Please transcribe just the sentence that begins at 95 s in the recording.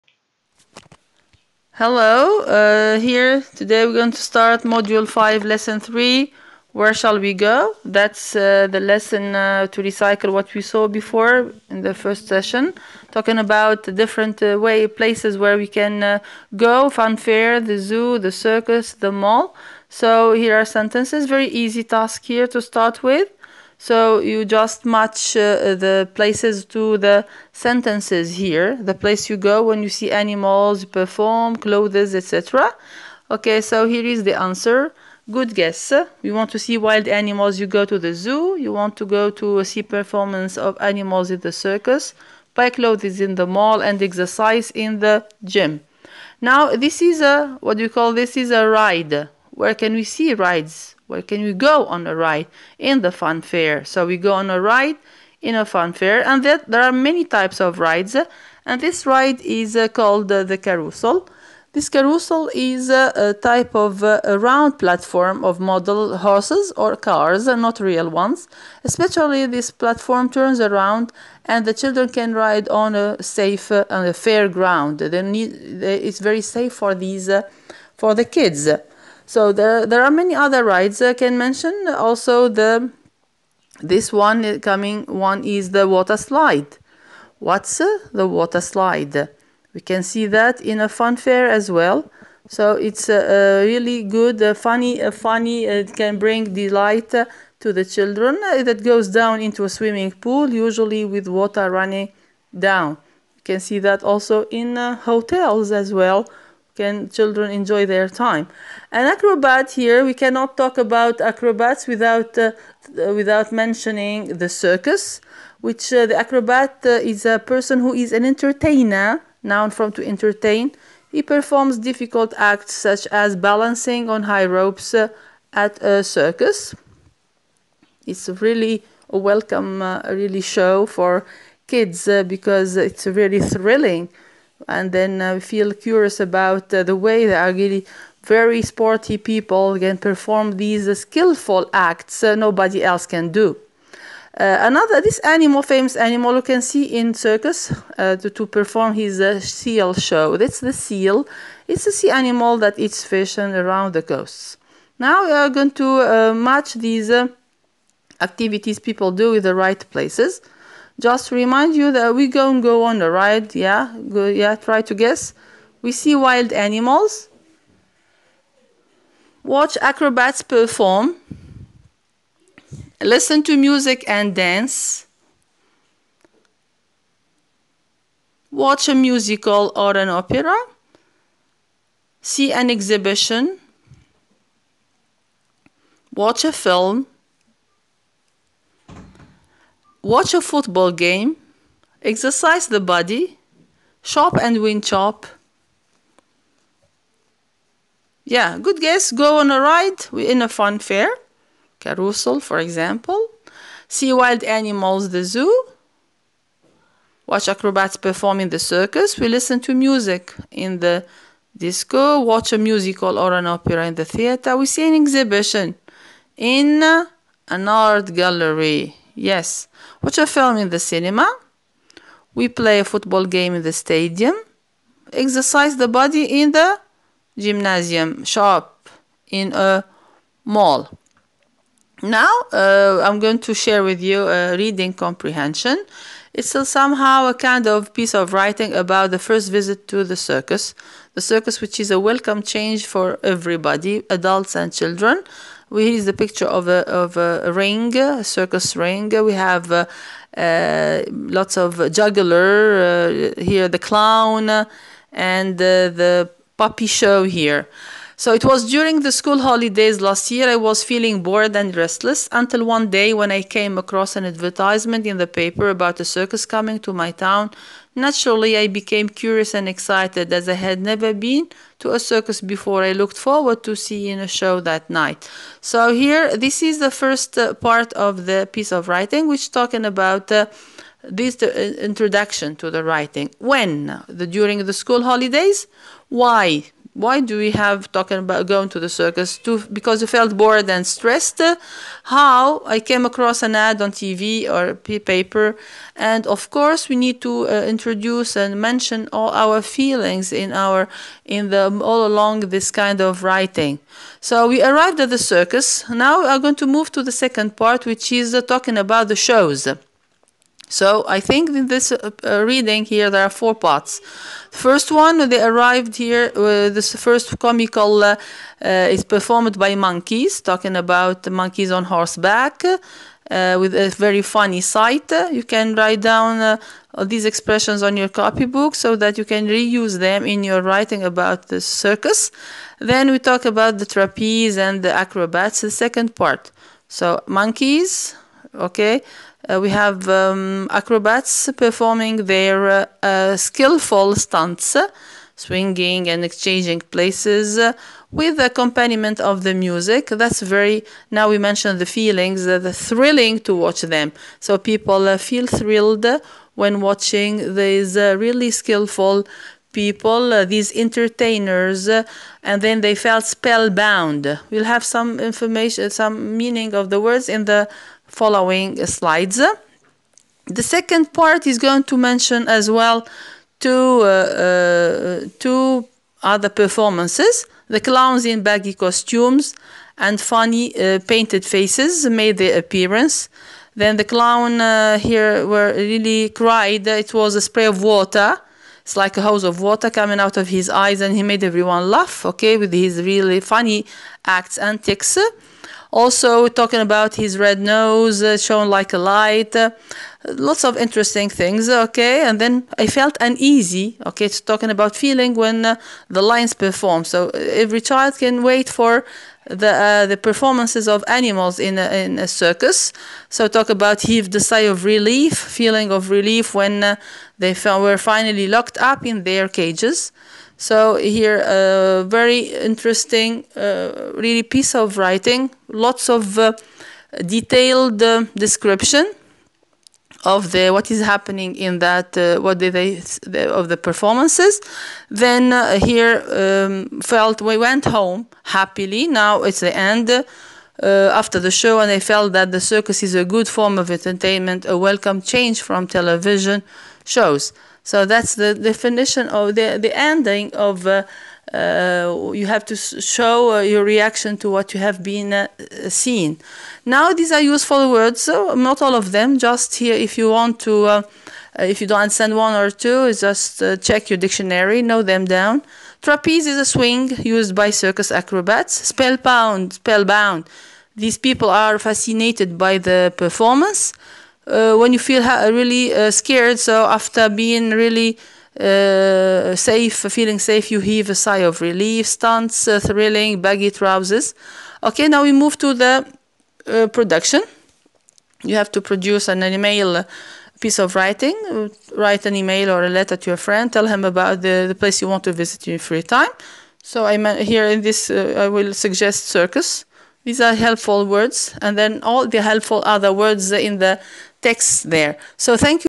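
Uh, it can bring delight uh, to the children.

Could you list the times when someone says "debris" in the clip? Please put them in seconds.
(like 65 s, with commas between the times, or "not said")
not said.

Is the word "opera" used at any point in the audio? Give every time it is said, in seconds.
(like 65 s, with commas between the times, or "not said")
180 s, 213 s.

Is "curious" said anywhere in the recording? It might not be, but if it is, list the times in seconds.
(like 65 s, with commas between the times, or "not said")
135 s, 269 s.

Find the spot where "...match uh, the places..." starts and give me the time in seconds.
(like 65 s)
24 s.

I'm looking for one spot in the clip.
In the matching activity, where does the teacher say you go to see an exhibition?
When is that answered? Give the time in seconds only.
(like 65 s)
216 s.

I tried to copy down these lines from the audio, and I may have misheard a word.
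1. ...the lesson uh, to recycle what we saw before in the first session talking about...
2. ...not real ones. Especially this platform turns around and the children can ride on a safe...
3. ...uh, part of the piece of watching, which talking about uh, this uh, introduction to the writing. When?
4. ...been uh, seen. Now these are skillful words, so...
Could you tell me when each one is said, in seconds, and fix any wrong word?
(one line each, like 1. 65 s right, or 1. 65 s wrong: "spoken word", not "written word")
1. 8 s right
2. 67 s right
3. 277 s wrong: "writing", not "watching"
4. 455 s wrong: "useful", not "skillful".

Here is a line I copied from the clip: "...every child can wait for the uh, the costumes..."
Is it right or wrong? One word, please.
wrong.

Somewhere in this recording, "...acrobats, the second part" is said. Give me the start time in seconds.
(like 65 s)
334 s.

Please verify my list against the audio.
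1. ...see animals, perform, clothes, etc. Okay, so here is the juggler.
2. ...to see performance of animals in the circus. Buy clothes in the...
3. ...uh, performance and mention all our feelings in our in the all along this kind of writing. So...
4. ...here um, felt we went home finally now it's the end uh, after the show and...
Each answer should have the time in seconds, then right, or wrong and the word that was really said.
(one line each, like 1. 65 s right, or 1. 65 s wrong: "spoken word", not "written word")
1. 29 s wrong: "answer", not "juggler"
2. 39 s right
3. 297 s wrong: "introduce", not "performance"
4. 435 s wrong: "happily", not "finally".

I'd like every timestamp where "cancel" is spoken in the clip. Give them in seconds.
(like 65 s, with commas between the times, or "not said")
not said.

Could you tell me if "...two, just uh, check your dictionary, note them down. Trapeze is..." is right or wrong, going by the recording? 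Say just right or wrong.
right.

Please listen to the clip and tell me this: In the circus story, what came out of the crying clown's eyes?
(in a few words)
spray of water.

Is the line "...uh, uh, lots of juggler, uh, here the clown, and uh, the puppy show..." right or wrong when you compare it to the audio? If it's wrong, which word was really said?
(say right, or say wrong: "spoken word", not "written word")
right.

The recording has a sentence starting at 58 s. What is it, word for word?
And this ride is uh, called uh, the carousel.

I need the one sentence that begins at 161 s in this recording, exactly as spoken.
Just remind you that we go and go on the ride, Yeah, go, yeah, try to guess.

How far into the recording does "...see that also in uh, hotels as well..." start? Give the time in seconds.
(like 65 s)
103 s.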